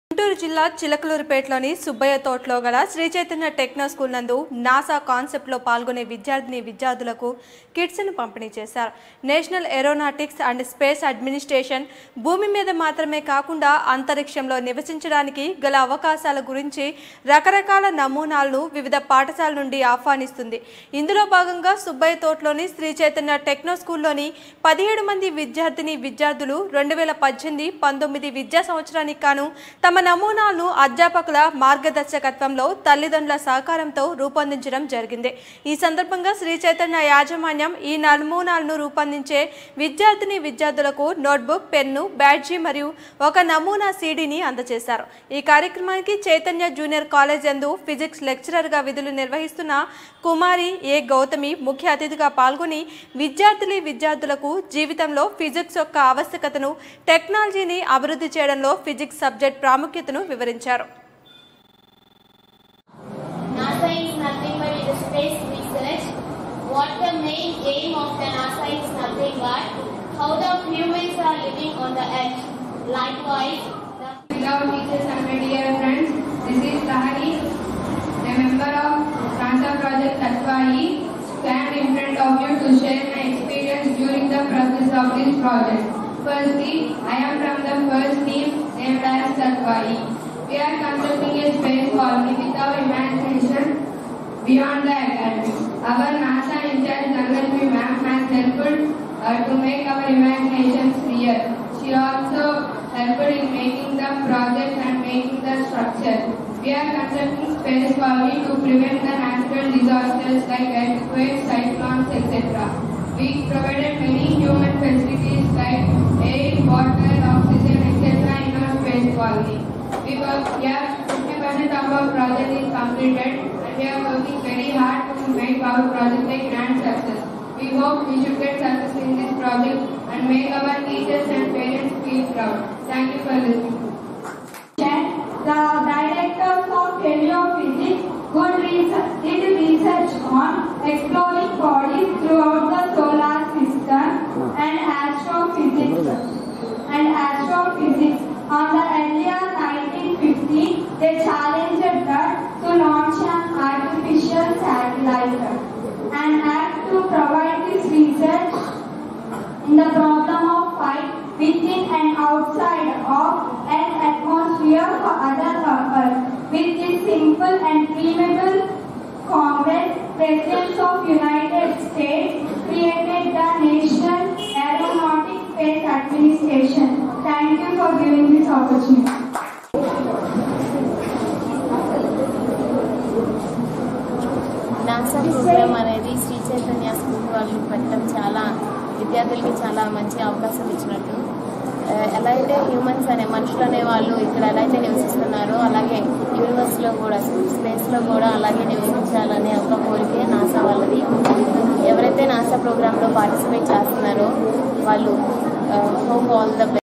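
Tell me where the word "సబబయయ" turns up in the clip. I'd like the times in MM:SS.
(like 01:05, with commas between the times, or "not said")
00:01, 00:21.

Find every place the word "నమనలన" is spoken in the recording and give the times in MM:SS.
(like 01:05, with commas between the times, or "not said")
00:18, 00:30, 00:38.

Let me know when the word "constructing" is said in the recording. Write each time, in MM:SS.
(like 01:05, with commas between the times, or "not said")
01:30, 01:46.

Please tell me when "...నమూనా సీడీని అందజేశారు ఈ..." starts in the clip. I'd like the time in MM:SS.
00:43.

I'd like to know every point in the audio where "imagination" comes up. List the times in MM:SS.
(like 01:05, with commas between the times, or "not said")
01:32, 01:40.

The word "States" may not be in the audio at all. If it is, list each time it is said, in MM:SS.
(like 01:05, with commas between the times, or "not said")
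02:51.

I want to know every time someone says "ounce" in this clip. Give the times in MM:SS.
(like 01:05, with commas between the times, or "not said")
not said.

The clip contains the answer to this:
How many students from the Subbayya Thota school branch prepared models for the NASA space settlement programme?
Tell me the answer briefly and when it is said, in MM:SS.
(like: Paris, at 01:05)
17, at 00:24.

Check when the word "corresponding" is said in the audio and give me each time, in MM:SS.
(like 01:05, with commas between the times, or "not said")
not said.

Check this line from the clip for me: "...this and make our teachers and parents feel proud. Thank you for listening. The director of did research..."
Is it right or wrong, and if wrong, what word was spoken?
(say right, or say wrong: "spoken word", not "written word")
right.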